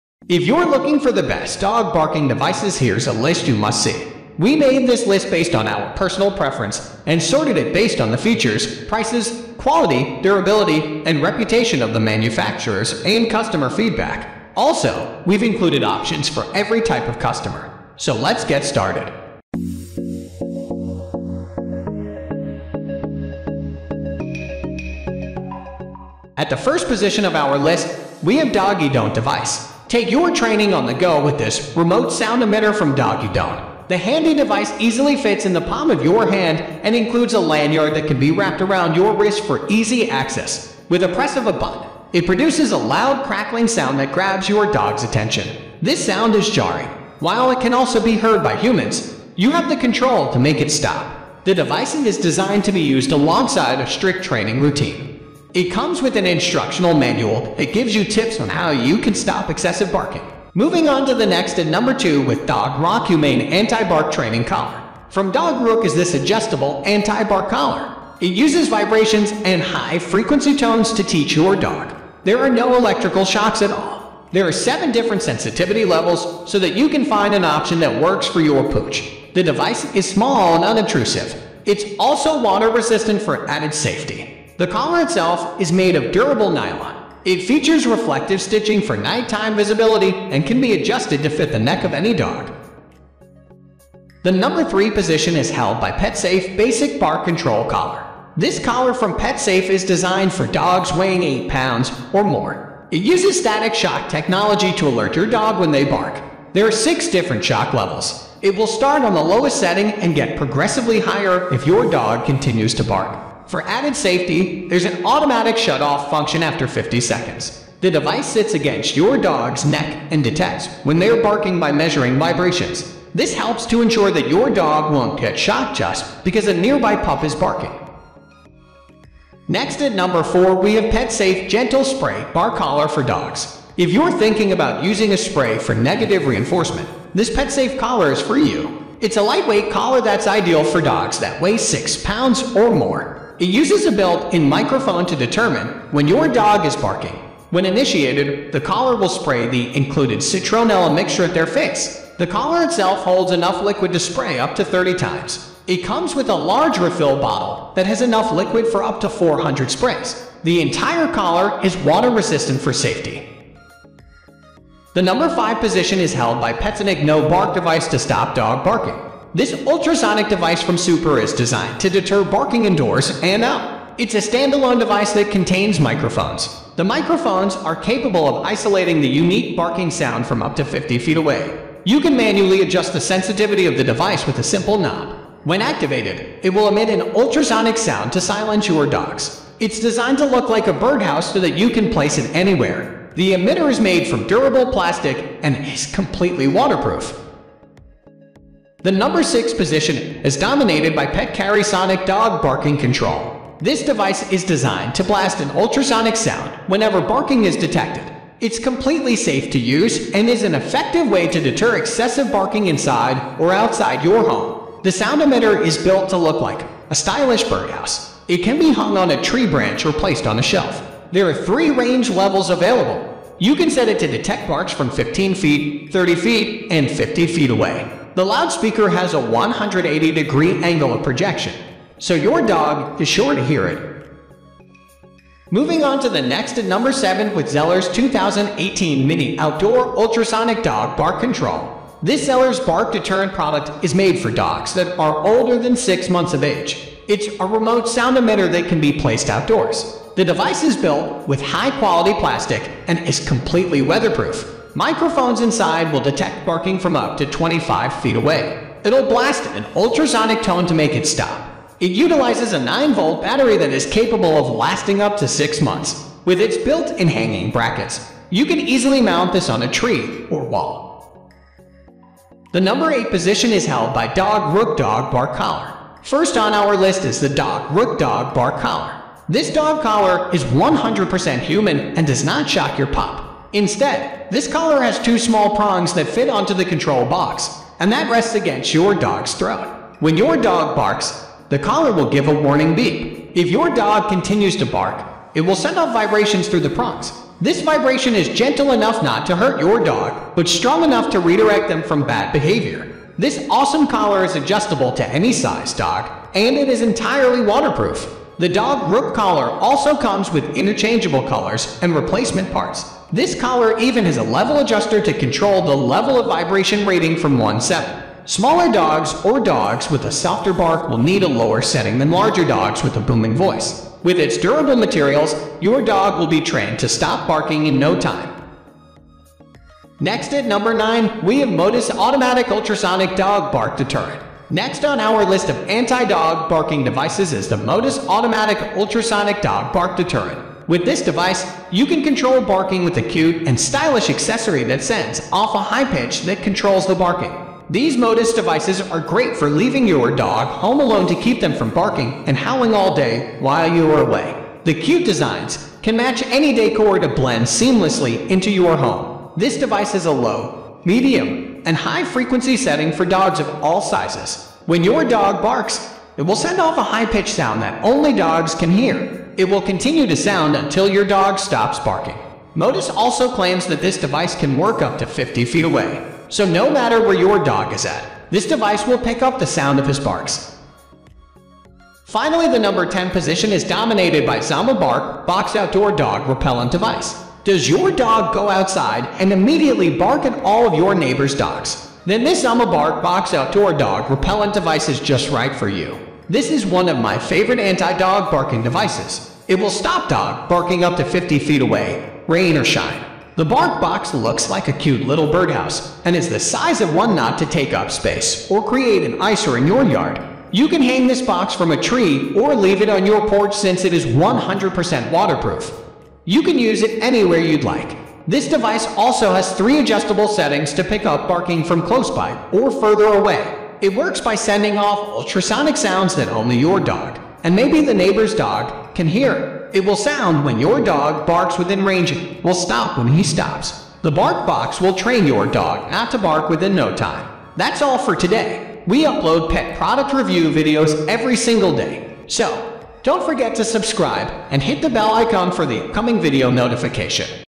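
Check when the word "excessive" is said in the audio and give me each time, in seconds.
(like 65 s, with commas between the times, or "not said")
59 s, 211 s.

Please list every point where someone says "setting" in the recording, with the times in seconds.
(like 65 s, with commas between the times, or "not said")
109 s, 321 s, 362 s, 420 s.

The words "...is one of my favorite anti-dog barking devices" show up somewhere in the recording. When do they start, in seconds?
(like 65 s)
396 s.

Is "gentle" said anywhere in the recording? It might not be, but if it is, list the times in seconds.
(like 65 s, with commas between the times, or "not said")
131 s, 298 s.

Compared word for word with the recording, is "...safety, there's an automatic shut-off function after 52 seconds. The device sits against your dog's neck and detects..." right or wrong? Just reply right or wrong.
wrong.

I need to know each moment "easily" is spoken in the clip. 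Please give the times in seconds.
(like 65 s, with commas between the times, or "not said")
34 s, 268 s.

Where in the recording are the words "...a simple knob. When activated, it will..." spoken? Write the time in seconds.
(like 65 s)
184 s.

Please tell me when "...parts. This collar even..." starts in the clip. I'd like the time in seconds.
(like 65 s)
312 s.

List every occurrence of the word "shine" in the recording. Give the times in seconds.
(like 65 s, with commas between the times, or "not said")
402 s.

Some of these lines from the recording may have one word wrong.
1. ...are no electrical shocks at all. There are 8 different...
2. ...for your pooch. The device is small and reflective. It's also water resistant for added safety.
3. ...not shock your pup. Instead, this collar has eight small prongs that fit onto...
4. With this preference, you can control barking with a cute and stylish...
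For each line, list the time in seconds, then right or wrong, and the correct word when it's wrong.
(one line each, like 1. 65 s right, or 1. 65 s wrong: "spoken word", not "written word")
1. 72 s wrong: "7", not "8"
2. 78 s wrong: "unobtrusive", not "reflective"
3. 282 s wrong: "two", not "eight"
4. 340 s wrong: "device", not "preference".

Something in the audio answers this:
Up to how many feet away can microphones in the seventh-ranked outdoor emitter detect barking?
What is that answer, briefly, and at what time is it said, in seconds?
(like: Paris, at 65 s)
25 feet, at 257 s.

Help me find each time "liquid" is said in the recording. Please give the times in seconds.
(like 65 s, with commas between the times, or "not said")
153 s, 158 s.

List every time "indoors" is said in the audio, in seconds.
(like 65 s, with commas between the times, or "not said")
172 s.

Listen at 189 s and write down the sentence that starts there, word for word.
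It's designed to look like a birdhouse so that you can place it anywhere.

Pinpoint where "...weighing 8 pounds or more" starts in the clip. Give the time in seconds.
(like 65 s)
100 s.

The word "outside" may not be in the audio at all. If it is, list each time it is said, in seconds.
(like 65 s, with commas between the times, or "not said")
213 s, 388 s.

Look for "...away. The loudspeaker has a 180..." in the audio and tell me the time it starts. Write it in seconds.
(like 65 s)
227 s.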